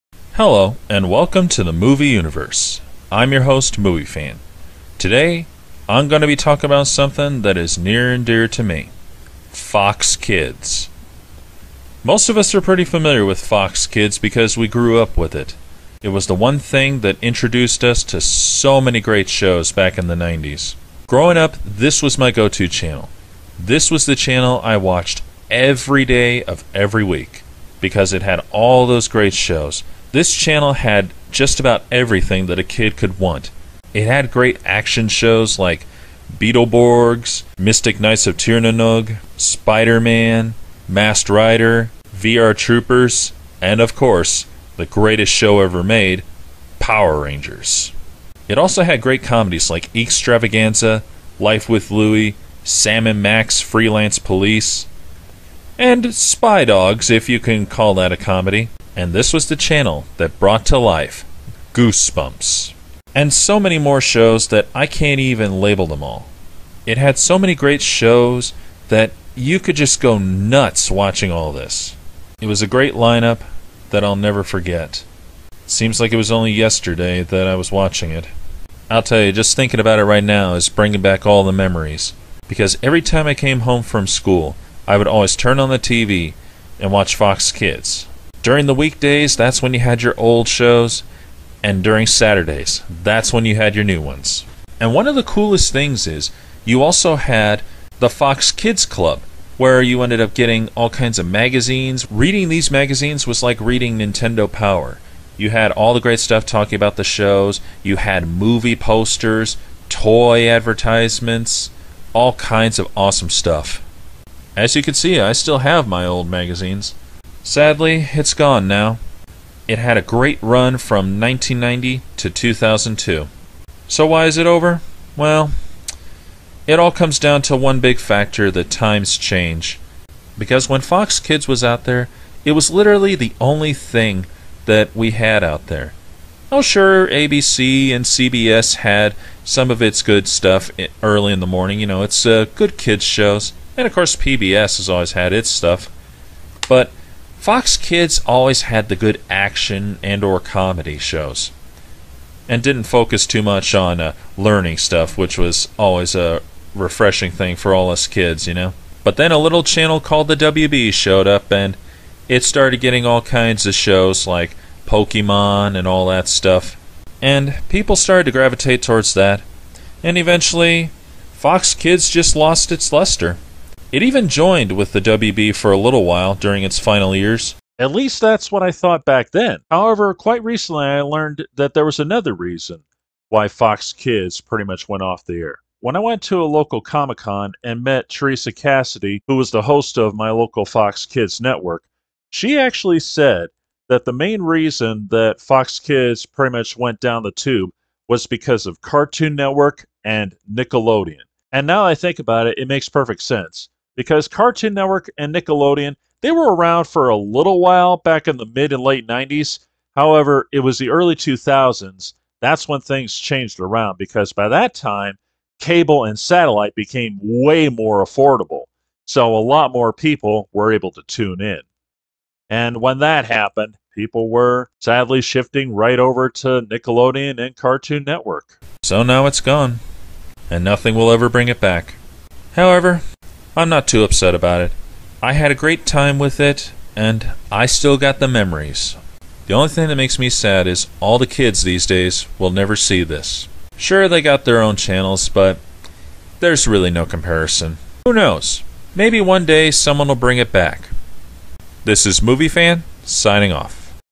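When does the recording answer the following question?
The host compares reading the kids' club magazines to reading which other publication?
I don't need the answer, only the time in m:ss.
1:43.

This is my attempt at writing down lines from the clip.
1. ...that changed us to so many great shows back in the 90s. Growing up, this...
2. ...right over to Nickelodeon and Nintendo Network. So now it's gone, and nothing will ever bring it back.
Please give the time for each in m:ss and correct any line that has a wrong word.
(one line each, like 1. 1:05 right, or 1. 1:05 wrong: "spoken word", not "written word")
1. 0:17 wrong: "introduced", not "changed"
2. 3:45 wrong: "Cartoon", not "Nintendo".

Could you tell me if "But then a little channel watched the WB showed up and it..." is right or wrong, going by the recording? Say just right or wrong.
wrong.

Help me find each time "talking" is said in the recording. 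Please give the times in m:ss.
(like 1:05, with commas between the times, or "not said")
0:06, 1:46.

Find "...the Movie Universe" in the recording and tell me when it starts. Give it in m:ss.
0:01.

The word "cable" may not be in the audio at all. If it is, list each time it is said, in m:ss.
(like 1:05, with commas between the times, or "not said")
3:35.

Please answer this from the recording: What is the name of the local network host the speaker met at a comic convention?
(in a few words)
Teresa Cassidy.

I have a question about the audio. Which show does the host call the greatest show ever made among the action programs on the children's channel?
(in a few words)
Power Rangers.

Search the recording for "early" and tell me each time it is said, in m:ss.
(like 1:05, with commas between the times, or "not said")
2:21, 3:30.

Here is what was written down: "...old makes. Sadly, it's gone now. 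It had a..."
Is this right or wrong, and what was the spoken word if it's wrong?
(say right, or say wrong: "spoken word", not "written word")
wrong: "magazines", not "makes".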